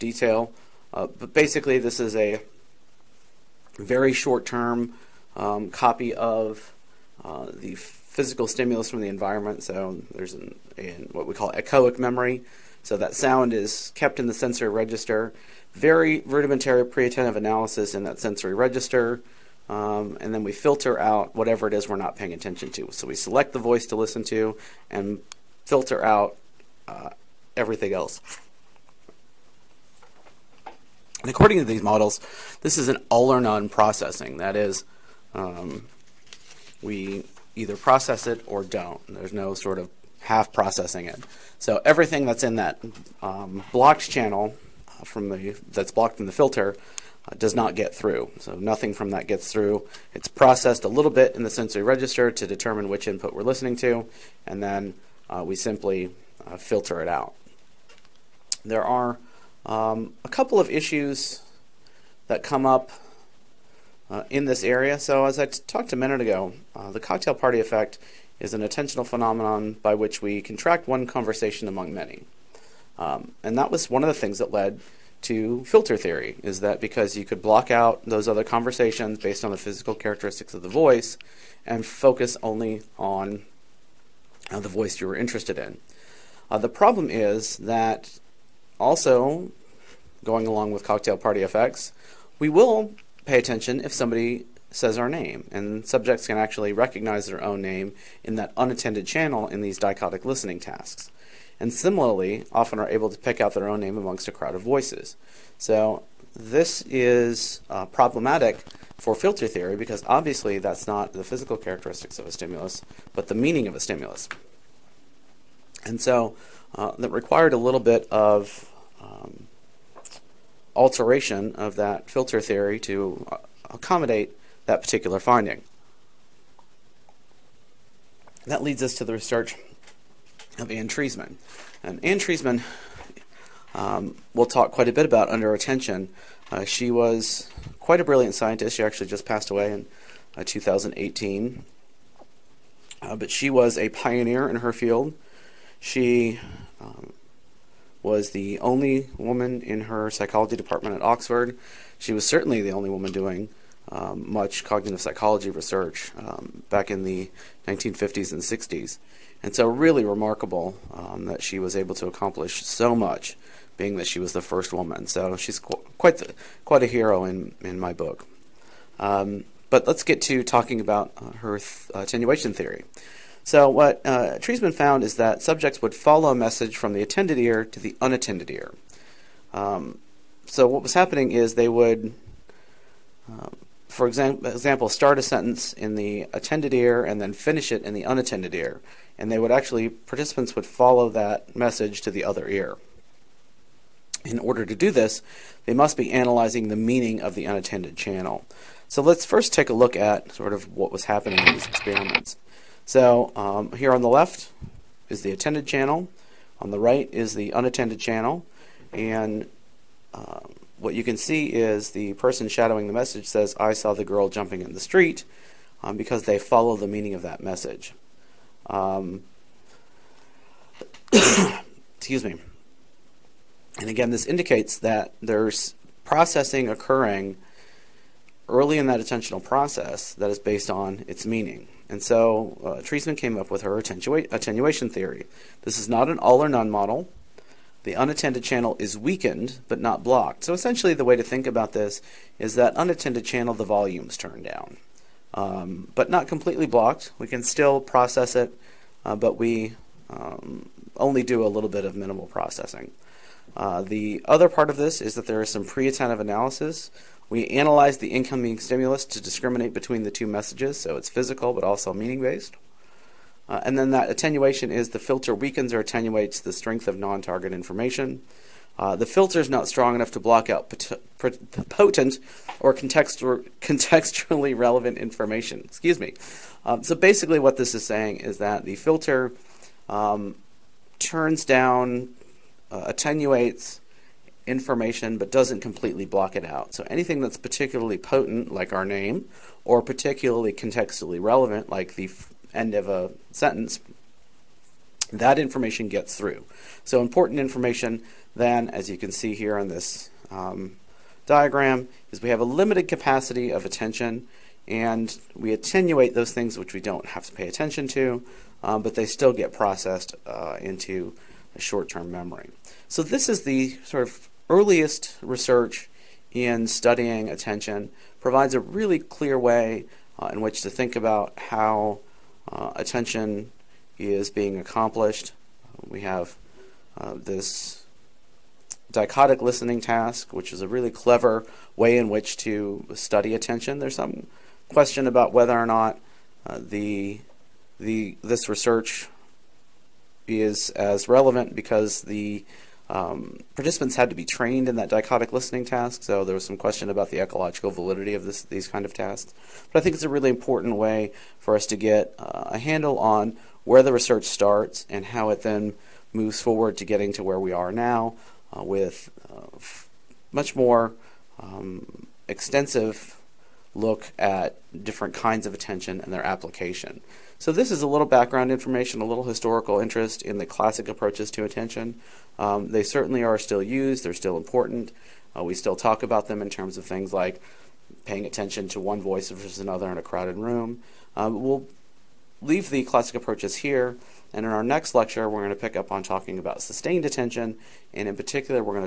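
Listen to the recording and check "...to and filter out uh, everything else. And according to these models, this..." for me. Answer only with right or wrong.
right.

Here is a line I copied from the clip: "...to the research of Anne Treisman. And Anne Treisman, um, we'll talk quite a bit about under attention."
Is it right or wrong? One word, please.
right.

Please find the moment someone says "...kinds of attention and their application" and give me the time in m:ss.
6:05.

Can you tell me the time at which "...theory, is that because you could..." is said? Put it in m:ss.
1:15.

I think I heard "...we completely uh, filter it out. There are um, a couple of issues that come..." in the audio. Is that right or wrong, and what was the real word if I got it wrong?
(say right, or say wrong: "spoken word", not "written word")
wrong: "simply", not "completely".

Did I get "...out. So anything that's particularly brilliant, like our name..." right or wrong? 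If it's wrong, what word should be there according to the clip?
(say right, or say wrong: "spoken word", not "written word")
wrong: "potent", not "brilliant".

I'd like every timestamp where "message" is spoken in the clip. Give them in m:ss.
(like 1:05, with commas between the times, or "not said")
2:56, 3:11, 3:32, 3:37, 4:20.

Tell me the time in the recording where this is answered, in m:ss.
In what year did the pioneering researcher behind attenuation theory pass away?
2:20.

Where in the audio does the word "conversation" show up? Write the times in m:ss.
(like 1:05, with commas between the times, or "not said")
1:11, 1:18.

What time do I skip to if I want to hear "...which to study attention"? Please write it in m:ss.
5:32.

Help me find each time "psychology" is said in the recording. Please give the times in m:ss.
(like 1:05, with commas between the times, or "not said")
2:30, 2:34.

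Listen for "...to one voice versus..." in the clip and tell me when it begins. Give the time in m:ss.
6:18.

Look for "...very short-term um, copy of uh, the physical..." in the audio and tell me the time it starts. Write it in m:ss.
0:03.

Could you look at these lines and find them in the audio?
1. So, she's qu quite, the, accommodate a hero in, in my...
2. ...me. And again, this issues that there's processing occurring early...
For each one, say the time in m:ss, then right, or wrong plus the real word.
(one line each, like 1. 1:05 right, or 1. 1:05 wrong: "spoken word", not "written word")
1. 2:45 wrong: "quite", not "accommodate"
2. 3:42 wrong: "indicates", not "issues".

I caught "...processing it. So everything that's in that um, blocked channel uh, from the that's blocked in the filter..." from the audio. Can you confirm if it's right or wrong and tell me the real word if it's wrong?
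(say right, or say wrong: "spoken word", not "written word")
right.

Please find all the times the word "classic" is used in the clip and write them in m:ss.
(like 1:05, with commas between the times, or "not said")
6:10, 6:22.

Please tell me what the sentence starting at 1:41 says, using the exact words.
And similarly, often are able to pick out their own name amongst a crowd of voices.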